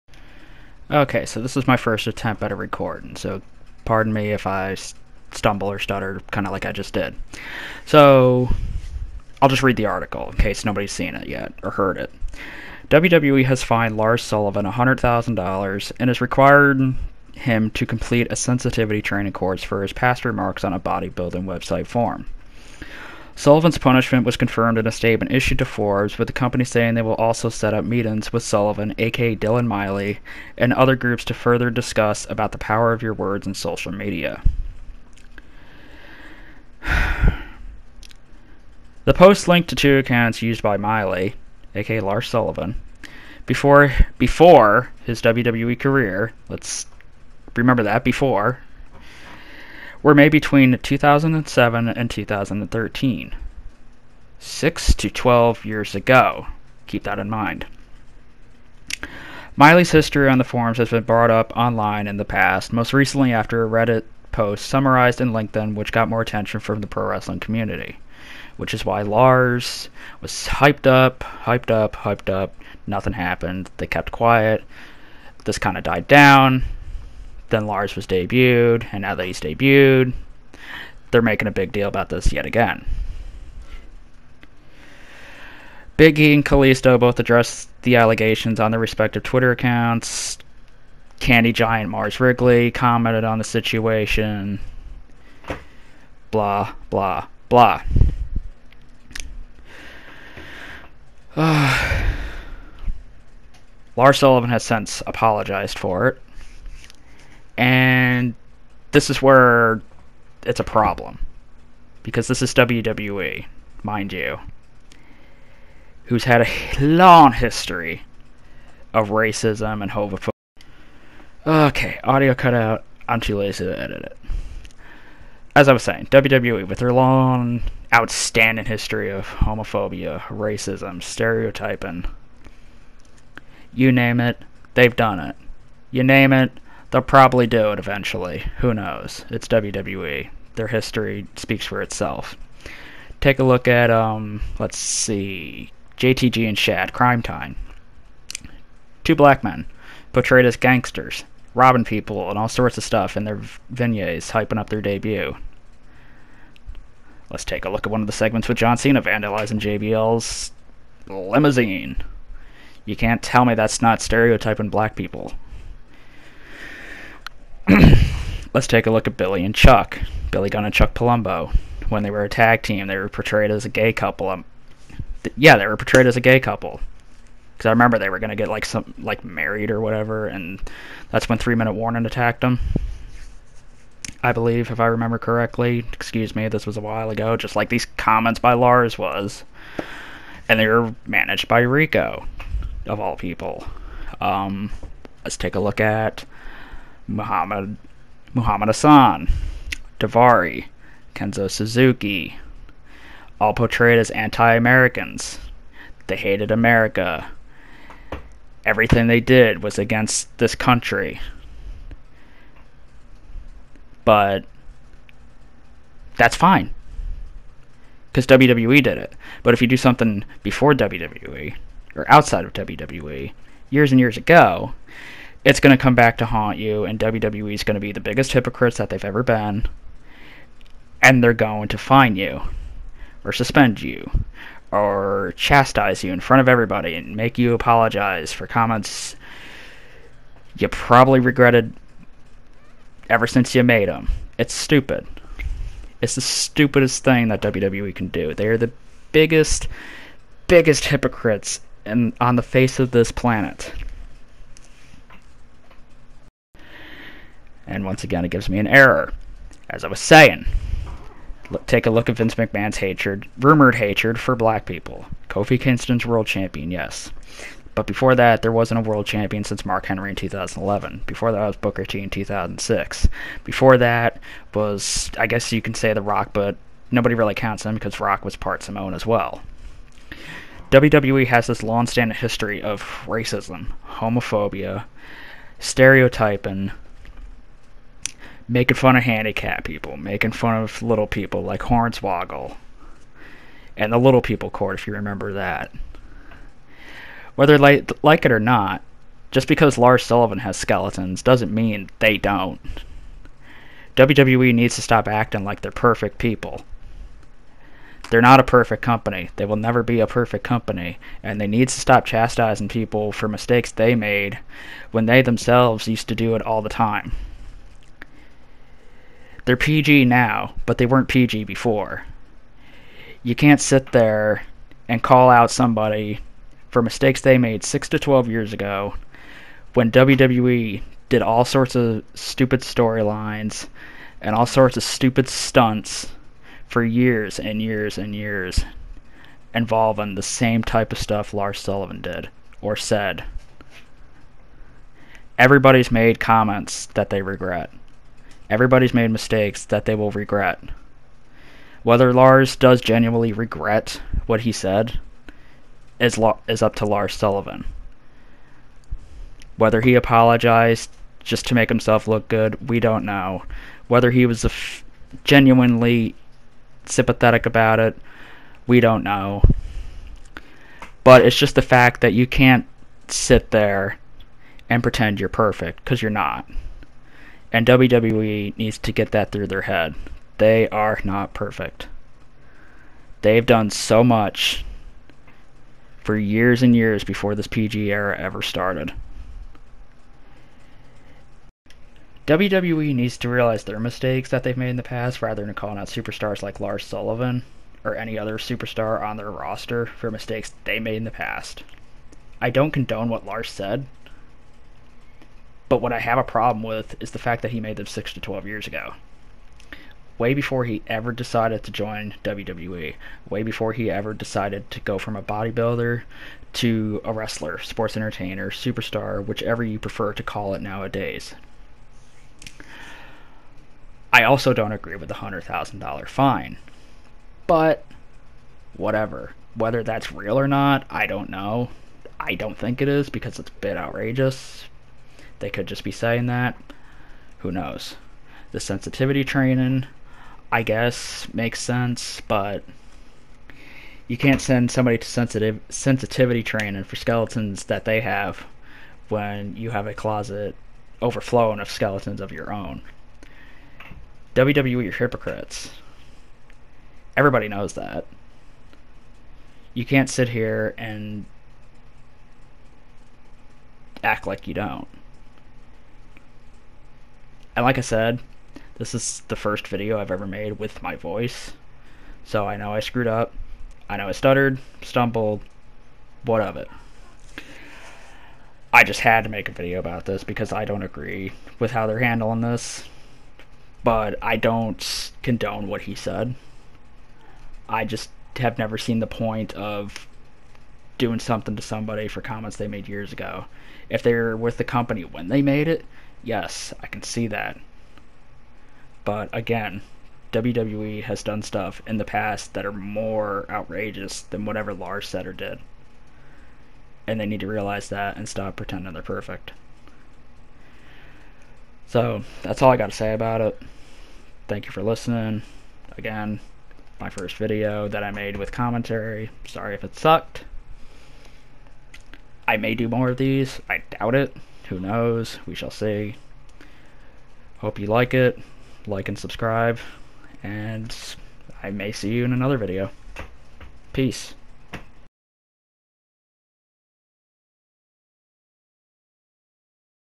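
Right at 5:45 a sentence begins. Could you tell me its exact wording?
Everybody's made comments that they regret.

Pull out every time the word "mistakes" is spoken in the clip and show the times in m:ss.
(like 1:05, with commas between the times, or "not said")
5:13, 5:26, 5:49, 6:33, 6:40.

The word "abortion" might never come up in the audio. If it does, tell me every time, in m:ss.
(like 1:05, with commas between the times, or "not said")
not said.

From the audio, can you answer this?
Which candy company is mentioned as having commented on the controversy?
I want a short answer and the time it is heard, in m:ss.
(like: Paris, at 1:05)
Mars Wrigley, at 1:31.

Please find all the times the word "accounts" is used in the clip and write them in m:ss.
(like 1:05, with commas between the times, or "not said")
0:39, 1:29.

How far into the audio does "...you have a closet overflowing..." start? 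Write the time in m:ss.
7:29.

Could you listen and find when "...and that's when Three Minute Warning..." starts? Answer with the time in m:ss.
3:00.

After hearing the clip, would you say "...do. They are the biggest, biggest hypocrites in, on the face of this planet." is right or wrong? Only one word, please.
right.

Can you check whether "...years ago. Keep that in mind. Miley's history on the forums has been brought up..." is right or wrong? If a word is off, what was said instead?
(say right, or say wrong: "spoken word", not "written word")
right.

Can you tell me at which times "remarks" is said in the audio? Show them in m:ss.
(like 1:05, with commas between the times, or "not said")
0:20.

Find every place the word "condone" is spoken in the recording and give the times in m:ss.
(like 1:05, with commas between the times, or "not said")
6:42, 8:05.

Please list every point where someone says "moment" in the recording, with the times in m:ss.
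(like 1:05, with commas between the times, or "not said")
not said.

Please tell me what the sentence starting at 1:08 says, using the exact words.
Which is why Lars was hyped up, hyped up, hyped up.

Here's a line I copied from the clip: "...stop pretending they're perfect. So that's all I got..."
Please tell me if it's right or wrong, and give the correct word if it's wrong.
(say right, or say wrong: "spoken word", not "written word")
right.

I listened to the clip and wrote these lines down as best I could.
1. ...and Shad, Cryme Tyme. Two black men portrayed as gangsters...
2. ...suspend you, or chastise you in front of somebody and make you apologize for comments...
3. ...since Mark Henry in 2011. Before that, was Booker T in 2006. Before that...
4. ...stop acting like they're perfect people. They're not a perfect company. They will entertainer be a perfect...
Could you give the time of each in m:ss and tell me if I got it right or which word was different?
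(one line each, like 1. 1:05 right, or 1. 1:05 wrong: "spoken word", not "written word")
1. 2:26 right
2. 3:53 wrong: "everybody", not "somebody"
3. 4:29 right
4. 5:04 wrong: "never", not "entertainer".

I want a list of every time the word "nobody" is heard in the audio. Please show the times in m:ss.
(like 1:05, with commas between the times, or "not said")
0:10, 4:36.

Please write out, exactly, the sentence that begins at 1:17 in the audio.
Then Lars was debuted, and now that he's debuted, they're making a big deal about this yet again.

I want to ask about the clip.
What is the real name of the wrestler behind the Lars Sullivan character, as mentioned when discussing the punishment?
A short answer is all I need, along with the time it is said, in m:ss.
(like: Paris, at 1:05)
Dylan Miley, at 0:29.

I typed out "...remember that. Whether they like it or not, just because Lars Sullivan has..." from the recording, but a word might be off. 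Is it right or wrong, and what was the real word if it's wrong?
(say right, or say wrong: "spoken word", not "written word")
right.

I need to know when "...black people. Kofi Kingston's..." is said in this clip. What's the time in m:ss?
4:24.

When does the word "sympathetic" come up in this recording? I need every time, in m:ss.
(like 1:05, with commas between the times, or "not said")
6:06.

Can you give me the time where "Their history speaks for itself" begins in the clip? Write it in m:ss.
2:20.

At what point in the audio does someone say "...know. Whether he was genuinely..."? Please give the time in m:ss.
6:03.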